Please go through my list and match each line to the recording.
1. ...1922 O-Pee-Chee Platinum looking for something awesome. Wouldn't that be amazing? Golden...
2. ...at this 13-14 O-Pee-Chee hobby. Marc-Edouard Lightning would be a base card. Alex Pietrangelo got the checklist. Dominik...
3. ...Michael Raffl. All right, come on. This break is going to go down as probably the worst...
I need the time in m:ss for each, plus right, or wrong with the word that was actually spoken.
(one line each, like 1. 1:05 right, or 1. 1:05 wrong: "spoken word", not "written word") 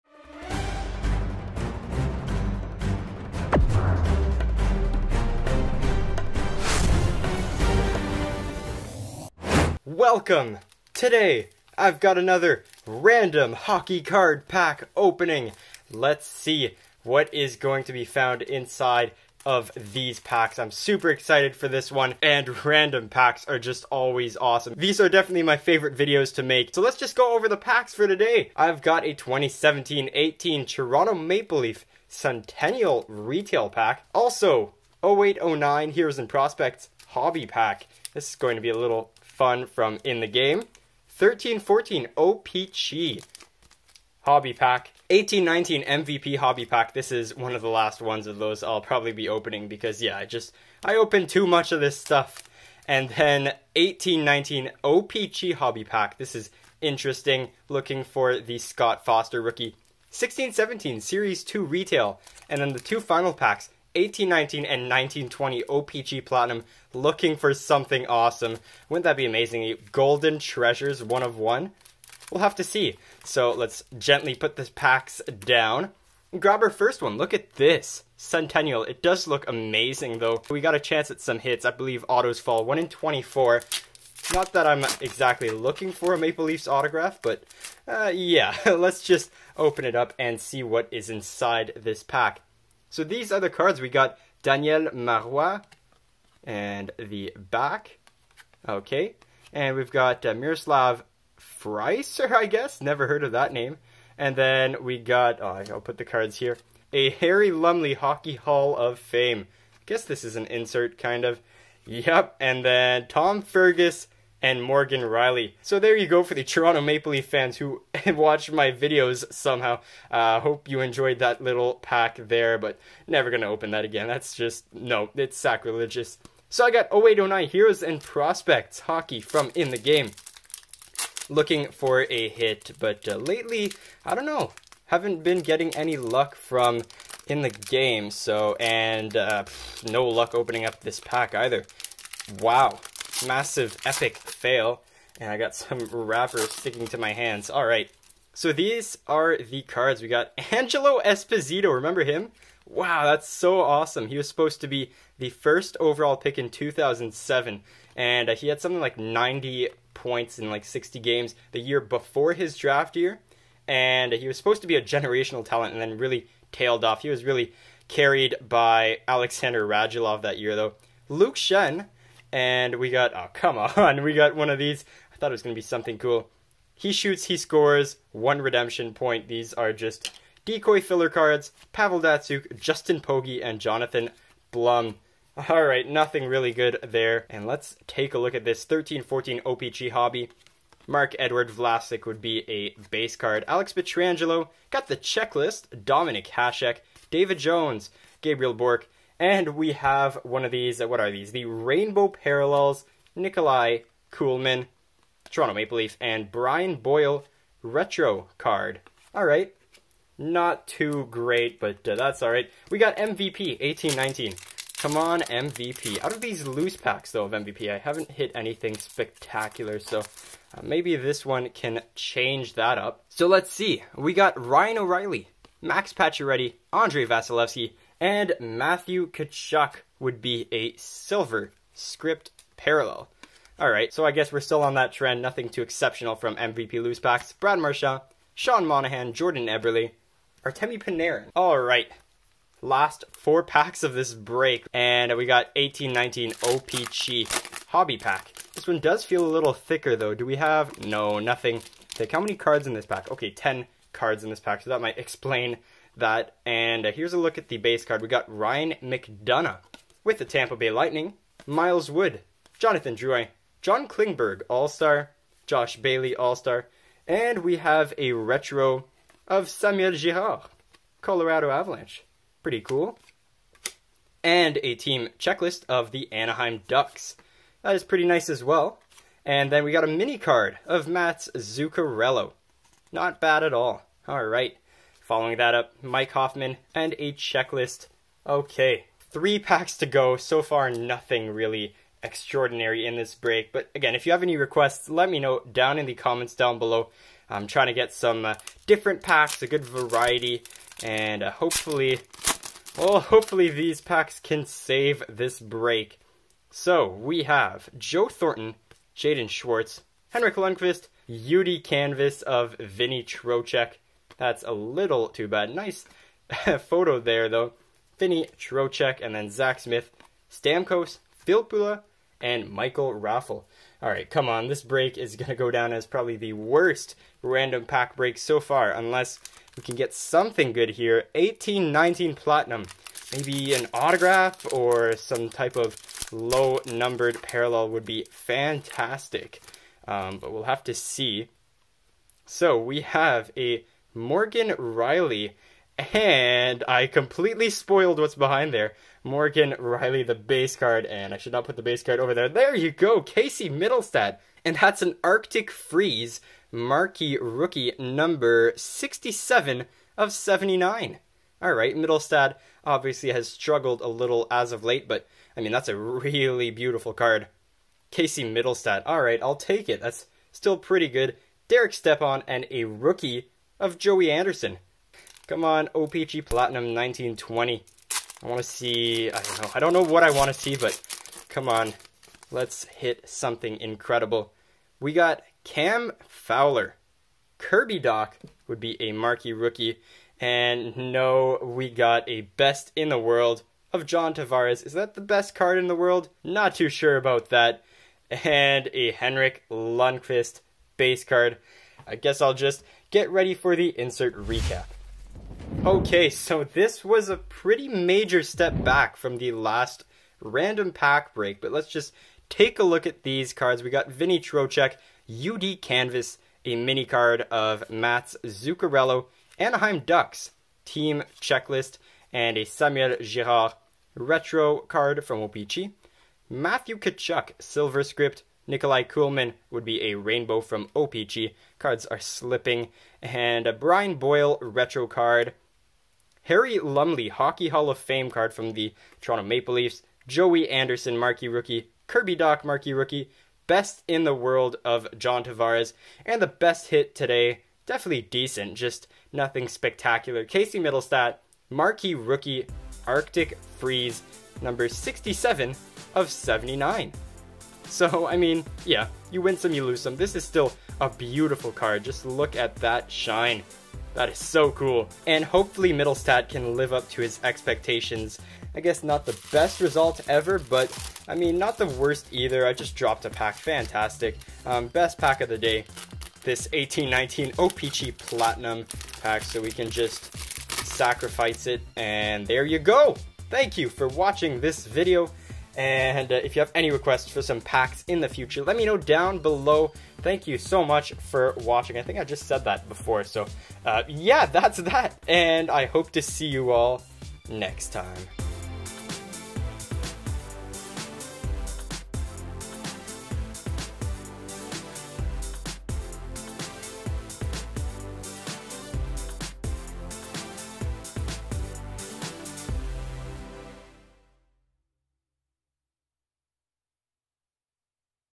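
1. 1:04 wrong: "1920", not "1922"
2. 3:08 wrong: "Vlasic", not "Lightning"
3. 5:22 right.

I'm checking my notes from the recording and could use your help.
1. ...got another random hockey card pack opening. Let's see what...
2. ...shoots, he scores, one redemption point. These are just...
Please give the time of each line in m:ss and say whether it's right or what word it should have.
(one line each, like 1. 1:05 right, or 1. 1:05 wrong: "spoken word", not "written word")
1. 0:11 right
2. 2:56 right.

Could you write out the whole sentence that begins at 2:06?
So I got 0809 Heroes and Prospects hockey from In The Game.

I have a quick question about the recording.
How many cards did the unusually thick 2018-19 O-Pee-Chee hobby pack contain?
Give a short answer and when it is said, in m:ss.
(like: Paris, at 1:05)
10, at 4:13.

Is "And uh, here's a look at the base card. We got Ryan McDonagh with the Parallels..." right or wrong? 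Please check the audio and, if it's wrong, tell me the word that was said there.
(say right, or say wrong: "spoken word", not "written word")
wrong: "Tampa", not "Parallels".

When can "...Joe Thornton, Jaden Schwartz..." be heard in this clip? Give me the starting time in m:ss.
5:07.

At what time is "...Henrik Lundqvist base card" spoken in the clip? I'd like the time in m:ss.
6:38.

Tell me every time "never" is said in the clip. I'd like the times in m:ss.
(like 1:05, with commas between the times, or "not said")
1:42, 2:03.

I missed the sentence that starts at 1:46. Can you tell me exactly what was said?
A Harry Lumley Hockey Hall of Fame.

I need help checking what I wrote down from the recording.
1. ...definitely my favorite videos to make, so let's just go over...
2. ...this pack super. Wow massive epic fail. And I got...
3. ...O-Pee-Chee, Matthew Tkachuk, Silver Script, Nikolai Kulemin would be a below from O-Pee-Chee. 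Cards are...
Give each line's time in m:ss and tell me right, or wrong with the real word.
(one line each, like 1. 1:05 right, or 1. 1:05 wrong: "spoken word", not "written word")
1. 0:25 right
2. 2:20 wrong: "either", not "super"
3. 7:05 wrong: "rainbow", not "below".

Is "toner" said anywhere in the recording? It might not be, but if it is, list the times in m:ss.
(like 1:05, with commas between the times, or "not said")
not said.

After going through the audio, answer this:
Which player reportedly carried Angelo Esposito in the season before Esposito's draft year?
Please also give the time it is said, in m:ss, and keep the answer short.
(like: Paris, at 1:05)
Alexander Radulov, at 2:49.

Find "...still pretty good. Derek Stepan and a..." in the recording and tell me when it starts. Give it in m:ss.
6:10.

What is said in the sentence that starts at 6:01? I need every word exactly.
All right, Mittelstadt obviously has struggled a little as of late, but I mean, that's a really beautiful card.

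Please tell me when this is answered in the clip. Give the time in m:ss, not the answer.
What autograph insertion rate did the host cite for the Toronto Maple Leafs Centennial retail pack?
1:22.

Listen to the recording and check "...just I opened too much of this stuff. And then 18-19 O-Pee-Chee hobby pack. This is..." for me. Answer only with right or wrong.
right.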